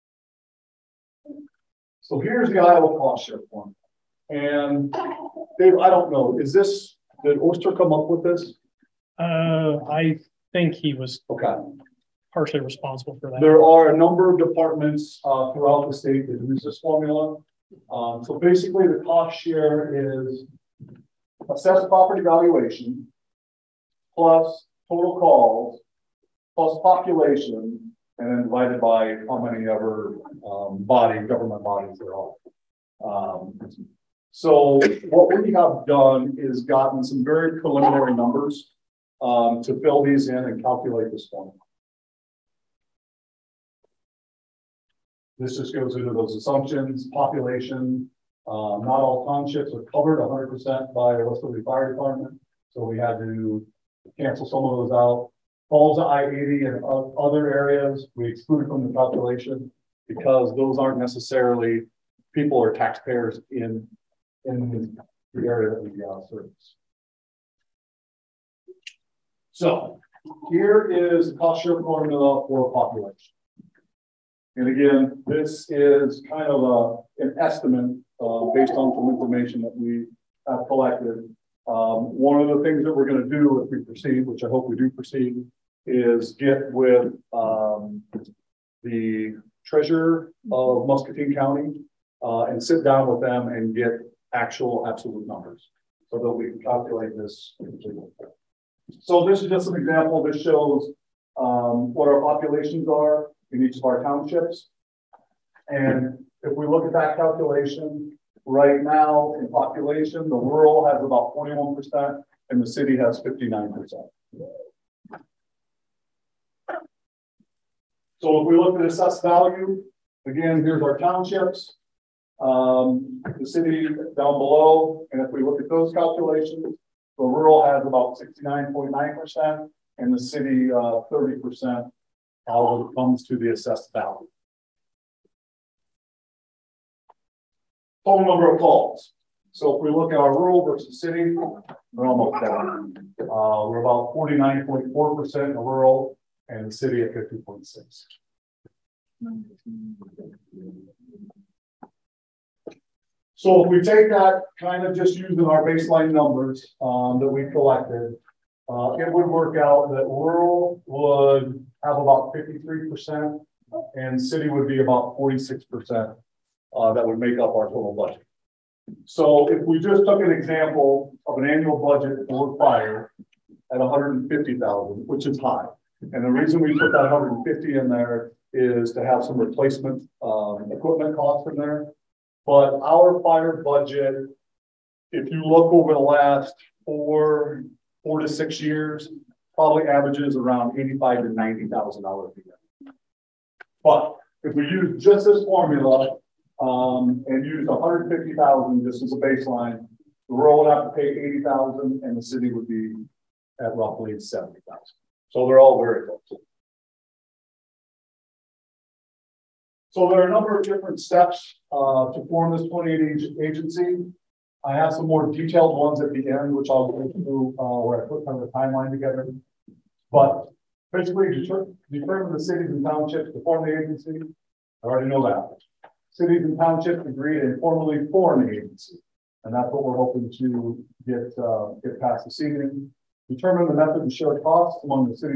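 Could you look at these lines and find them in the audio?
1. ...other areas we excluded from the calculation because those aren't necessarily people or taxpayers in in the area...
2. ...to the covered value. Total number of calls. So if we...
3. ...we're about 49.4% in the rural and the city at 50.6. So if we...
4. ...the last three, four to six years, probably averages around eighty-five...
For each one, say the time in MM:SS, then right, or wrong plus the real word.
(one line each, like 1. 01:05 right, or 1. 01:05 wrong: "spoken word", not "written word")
1. 00:57 right
2. 02:13 wrong: "assessed", not "covered"
3. 02:23 right
4. 03:05 wrong: "four", not "three".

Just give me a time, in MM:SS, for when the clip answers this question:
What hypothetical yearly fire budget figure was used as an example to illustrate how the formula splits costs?
02:53.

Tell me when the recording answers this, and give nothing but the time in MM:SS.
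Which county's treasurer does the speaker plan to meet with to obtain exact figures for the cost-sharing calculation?
01:30.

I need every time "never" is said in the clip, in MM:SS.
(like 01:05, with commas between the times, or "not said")
not said.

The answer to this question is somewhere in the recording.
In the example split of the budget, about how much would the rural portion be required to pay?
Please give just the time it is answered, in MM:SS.
03:21.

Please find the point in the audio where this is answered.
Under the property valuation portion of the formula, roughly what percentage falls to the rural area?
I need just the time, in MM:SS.
02:08.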